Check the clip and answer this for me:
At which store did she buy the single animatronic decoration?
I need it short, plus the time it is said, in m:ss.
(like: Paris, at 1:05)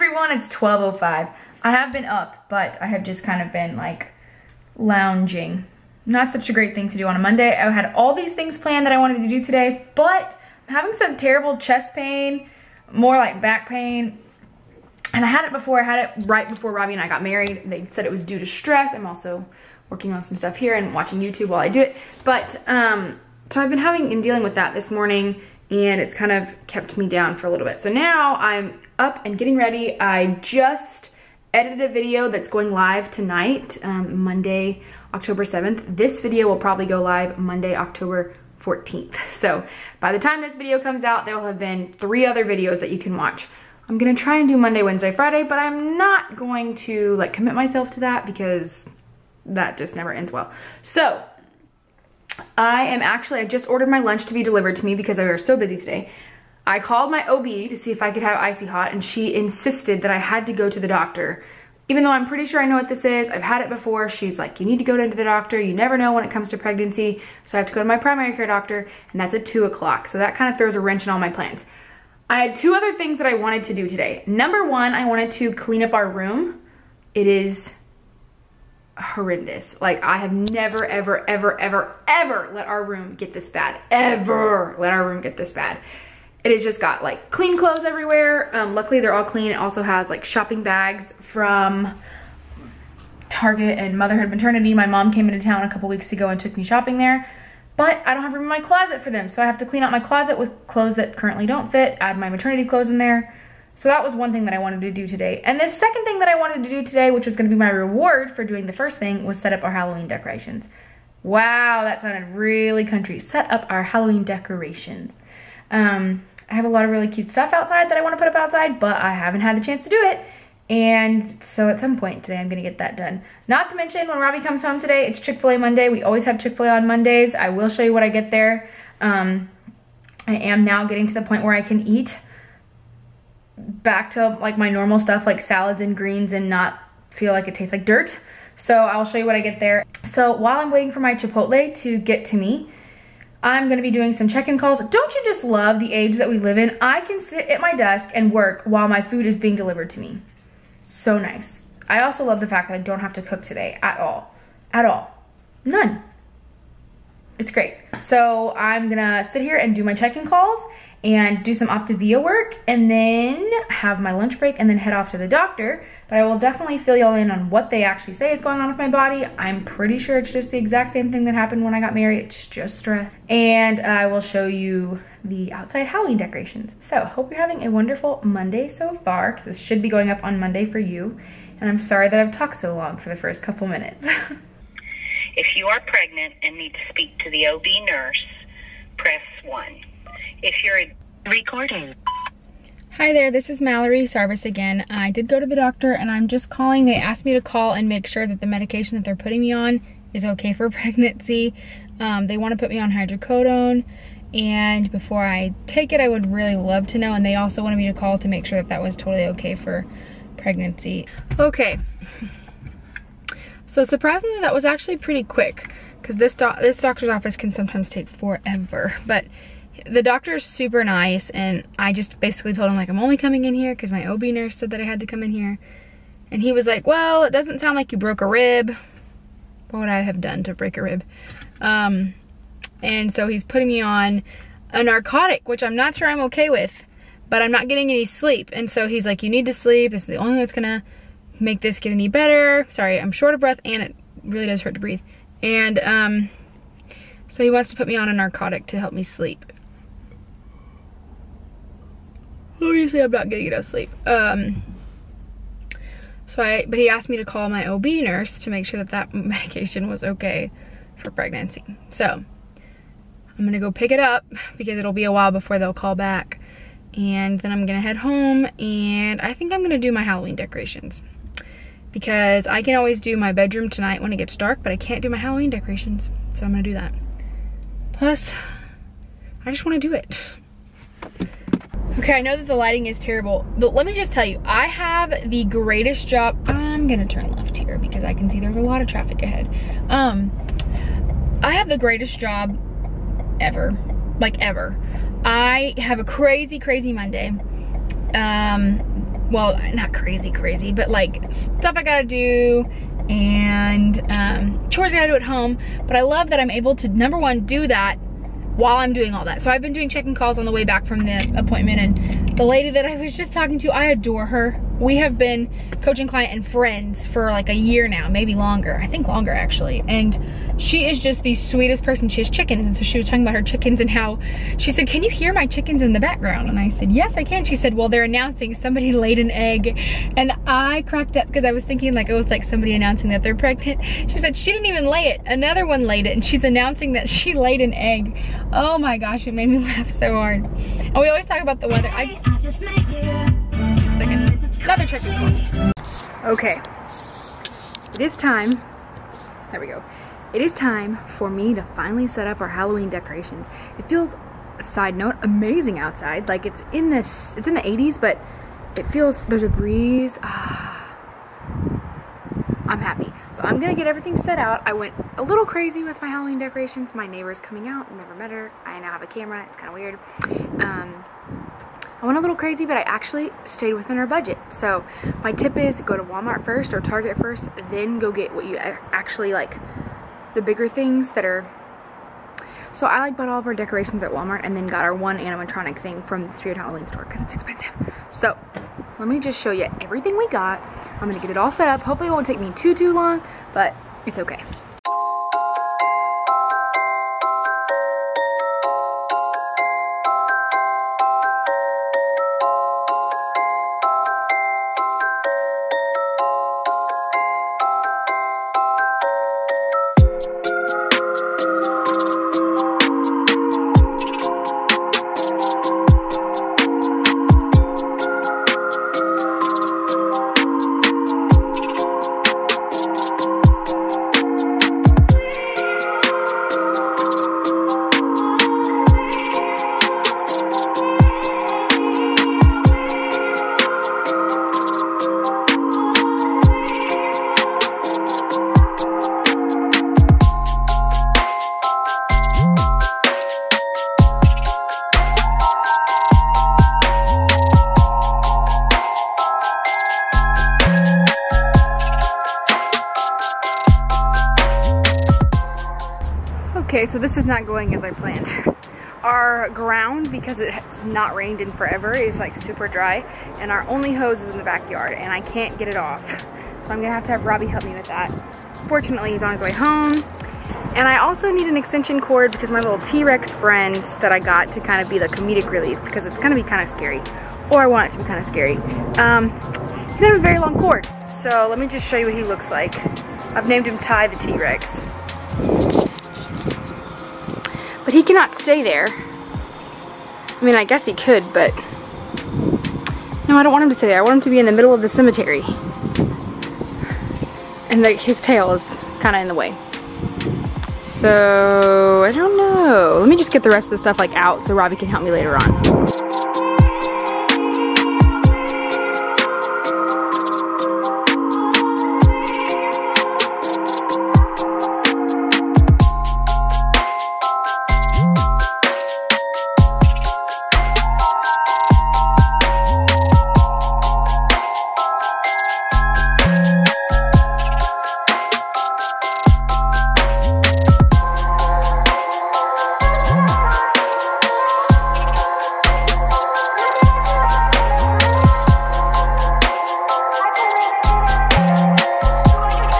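Spirit Halloween, at 6:26.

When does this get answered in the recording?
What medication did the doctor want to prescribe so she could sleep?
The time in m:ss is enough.
3:22.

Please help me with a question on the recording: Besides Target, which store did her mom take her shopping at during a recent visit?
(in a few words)
Motherhood Maternity.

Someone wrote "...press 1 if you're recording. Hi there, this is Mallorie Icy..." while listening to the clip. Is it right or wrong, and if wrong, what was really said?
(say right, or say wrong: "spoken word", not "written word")
wrong: "Sarvis", not "Icy".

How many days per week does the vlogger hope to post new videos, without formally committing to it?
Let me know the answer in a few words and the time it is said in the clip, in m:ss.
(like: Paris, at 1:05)
3, at 0:44.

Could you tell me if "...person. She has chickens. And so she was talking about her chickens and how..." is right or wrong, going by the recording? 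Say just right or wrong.
right.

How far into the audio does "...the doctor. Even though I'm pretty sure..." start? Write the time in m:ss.
1:00.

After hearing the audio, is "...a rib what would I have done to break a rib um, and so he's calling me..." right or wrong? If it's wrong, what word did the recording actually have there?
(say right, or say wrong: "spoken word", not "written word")
wrong: "putting", not "calling".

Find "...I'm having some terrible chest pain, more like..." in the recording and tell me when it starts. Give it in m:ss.
0:10.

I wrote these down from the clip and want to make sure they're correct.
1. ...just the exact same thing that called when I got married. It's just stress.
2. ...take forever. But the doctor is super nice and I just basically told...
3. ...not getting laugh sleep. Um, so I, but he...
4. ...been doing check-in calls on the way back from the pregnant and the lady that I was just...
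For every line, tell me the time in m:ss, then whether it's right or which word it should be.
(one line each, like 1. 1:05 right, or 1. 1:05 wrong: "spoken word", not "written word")
1. 2:50 wrong: "happened", not "called"
2. 3:37 right
3. 4:13 wrong: "enough", not "laugh"
4. 5:09 wrong: "appointment", not "pregnant".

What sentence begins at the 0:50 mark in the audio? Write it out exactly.
So I am actually, I just ordered my lunch to be delivered to me because I were so busy today.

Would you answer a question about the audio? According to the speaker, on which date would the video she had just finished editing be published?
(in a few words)
Monday, October 7th.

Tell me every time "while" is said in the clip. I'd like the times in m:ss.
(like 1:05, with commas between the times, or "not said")
0:21, 2:20, 2:28, 4:25, 5:08.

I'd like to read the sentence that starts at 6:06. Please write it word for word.
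My neighbor's coming out, never met her.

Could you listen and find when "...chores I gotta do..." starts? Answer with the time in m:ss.
5:04.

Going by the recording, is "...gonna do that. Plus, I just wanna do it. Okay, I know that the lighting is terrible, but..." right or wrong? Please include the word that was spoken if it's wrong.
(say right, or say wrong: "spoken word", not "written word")
right.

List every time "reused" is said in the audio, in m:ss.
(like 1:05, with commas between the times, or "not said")
not said.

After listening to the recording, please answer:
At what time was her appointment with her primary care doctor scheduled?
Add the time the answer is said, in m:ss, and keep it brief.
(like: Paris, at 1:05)
2:00, at 1:09.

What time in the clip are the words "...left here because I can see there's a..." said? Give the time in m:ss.
4:47.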